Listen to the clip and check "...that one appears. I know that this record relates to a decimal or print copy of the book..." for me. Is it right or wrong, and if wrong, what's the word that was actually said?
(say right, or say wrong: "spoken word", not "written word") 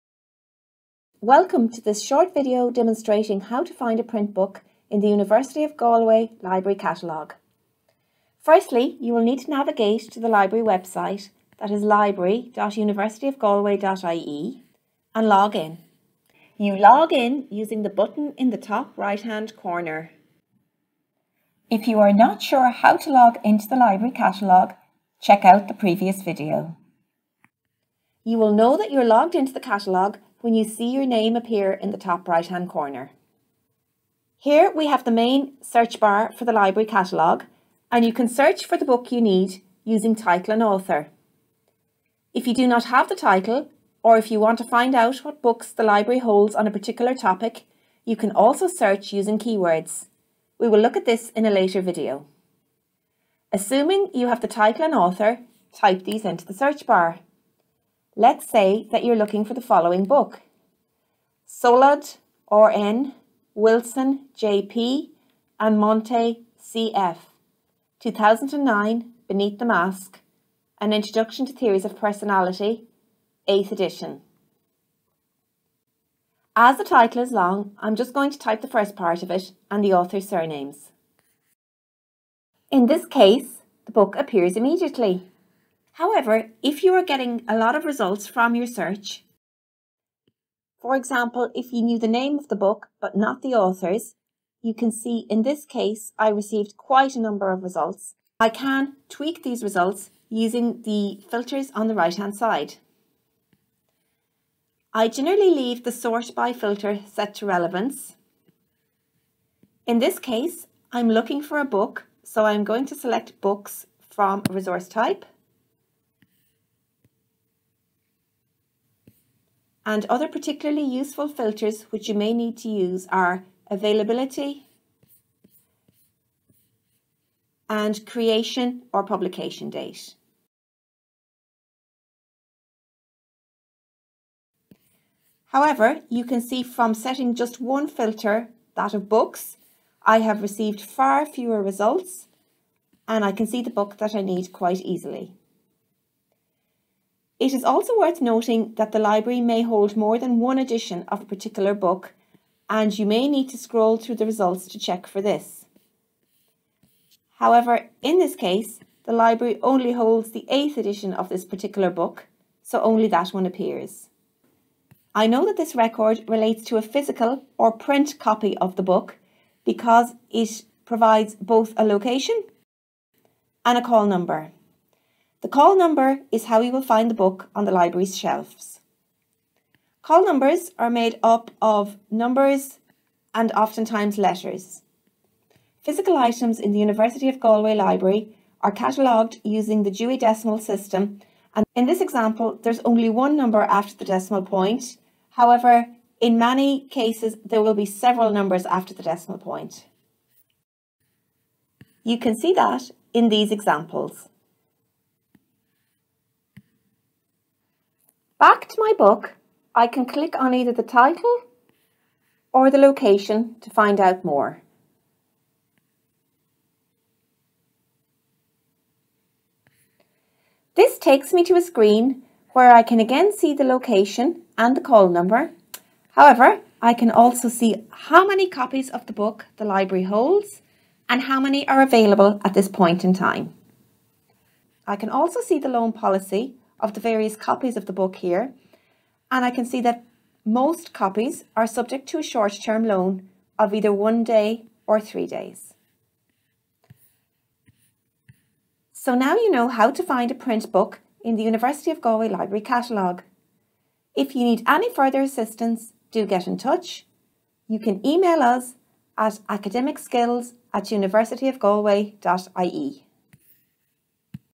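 wrong: "physical", not "decimal".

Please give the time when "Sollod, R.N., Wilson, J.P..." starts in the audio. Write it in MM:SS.
01:01.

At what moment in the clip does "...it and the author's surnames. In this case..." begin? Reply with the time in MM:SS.
01:19.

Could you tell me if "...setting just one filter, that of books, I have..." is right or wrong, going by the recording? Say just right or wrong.
right.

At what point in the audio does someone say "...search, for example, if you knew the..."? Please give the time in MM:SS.
01:28.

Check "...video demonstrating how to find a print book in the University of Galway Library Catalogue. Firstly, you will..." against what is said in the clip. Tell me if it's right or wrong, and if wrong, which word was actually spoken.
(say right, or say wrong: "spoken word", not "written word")
right.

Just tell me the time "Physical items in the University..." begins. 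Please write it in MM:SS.
03:05.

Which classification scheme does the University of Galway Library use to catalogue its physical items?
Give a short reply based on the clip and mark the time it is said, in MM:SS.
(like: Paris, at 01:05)
Dewey Decimal System, at 03:09.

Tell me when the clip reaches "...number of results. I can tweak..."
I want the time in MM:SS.
01:37.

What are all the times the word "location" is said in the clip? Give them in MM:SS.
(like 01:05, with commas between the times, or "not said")
02:51, 03:32, 03:43.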